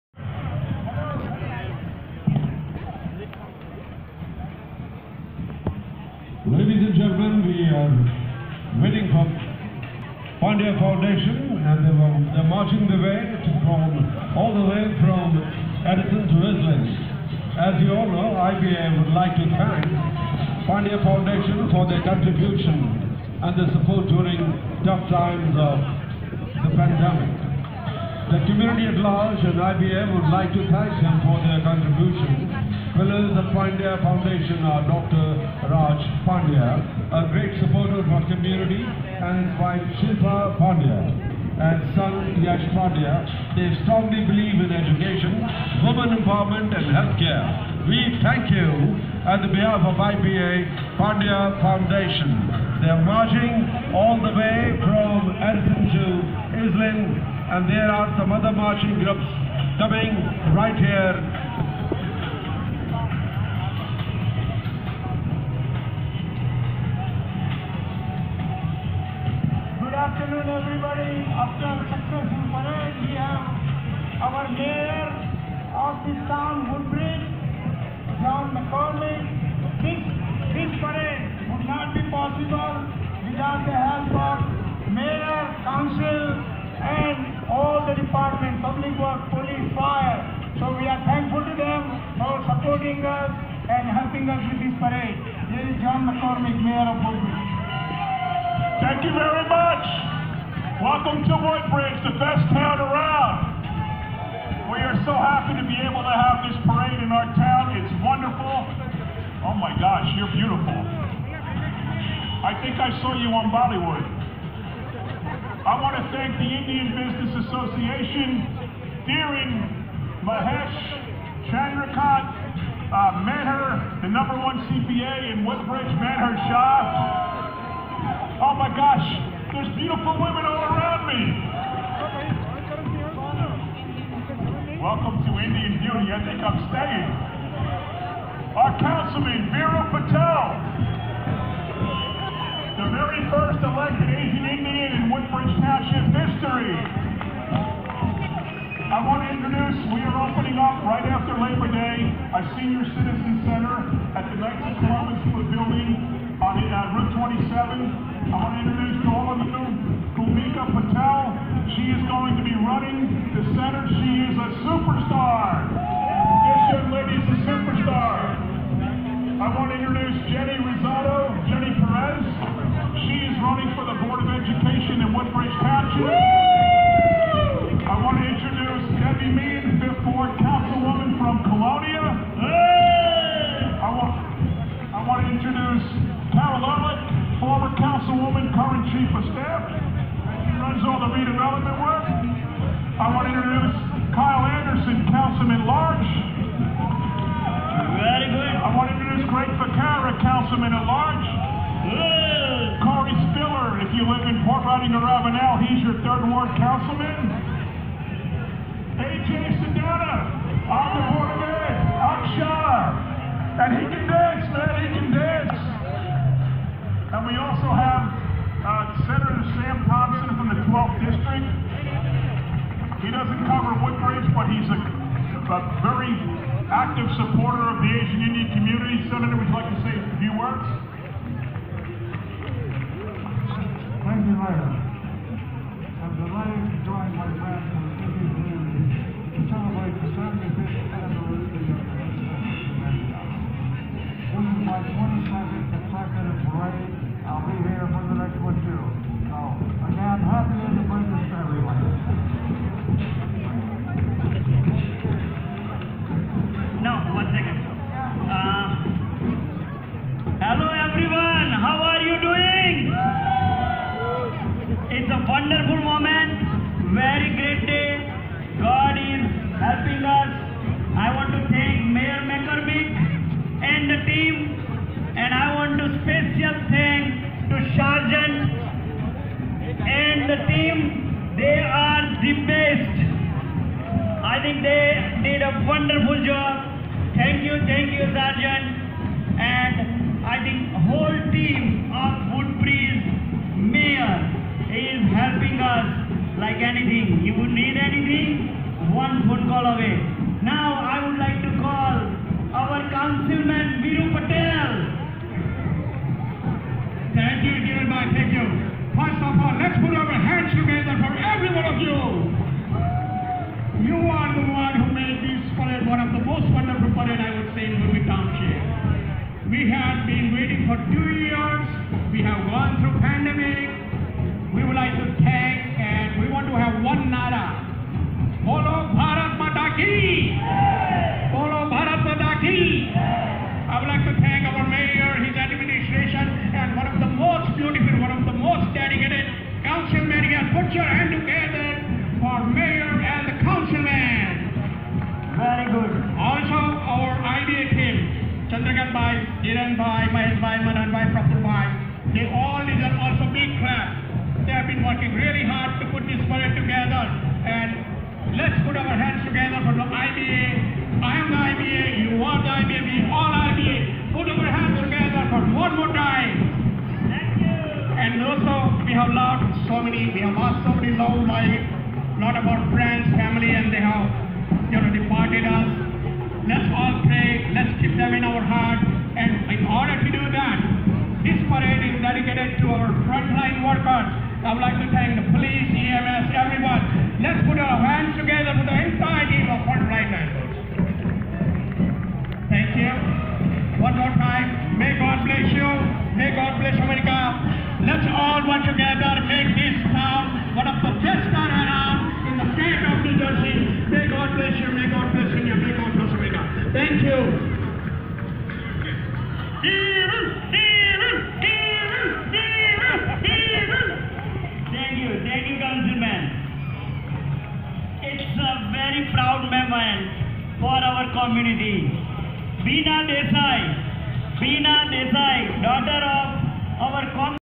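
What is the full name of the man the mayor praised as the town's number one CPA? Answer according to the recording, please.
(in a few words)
Manher Shah.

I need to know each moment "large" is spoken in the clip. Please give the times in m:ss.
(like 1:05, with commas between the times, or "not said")
0:28, 3:15, 3:20.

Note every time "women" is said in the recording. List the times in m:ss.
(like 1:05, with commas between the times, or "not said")
0:45, 2:10.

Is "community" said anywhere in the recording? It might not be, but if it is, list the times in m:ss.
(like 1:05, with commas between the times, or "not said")
0:28, 0:38, 3:48.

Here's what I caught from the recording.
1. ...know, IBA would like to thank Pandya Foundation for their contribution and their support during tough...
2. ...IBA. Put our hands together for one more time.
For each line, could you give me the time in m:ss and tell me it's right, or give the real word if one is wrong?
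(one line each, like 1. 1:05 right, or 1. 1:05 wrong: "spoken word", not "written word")
1. 0:18 right
2. 6:03 right.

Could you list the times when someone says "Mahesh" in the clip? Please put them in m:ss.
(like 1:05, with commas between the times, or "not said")
2:00, 5:50.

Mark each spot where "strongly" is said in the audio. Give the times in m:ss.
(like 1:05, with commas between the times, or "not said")
0:43.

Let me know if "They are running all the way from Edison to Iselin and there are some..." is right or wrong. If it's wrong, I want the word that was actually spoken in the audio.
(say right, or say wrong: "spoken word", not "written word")
wrong: "marching", not "running".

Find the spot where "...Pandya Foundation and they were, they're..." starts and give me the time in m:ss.
0:10.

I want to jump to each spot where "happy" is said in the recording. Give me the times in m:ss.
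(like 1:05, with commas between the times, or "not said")
1:45.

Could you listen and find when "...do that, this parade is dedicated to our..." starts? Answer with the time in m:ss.
6:20.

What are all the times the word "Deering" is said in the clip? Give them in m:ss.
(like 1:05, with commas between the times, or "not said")
1:59.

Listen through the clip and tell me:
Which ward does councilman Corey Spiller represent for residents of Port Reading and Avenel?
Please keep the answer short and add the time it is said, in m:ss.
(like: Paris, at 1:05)
Third ward, at 3:26.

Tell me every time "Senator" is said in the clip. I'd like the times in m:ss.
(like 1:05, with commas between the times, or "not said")
3:39, 3:49.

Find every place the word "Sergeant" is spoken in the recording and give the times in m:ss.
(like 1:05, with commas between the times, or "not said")
4:37, 4:48.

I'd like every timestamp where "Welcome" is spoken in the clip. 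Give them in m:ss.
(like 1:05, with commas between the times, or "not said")
1:40, 2:14.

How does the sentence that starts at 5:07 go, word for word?
Thank you, dear my Thank you.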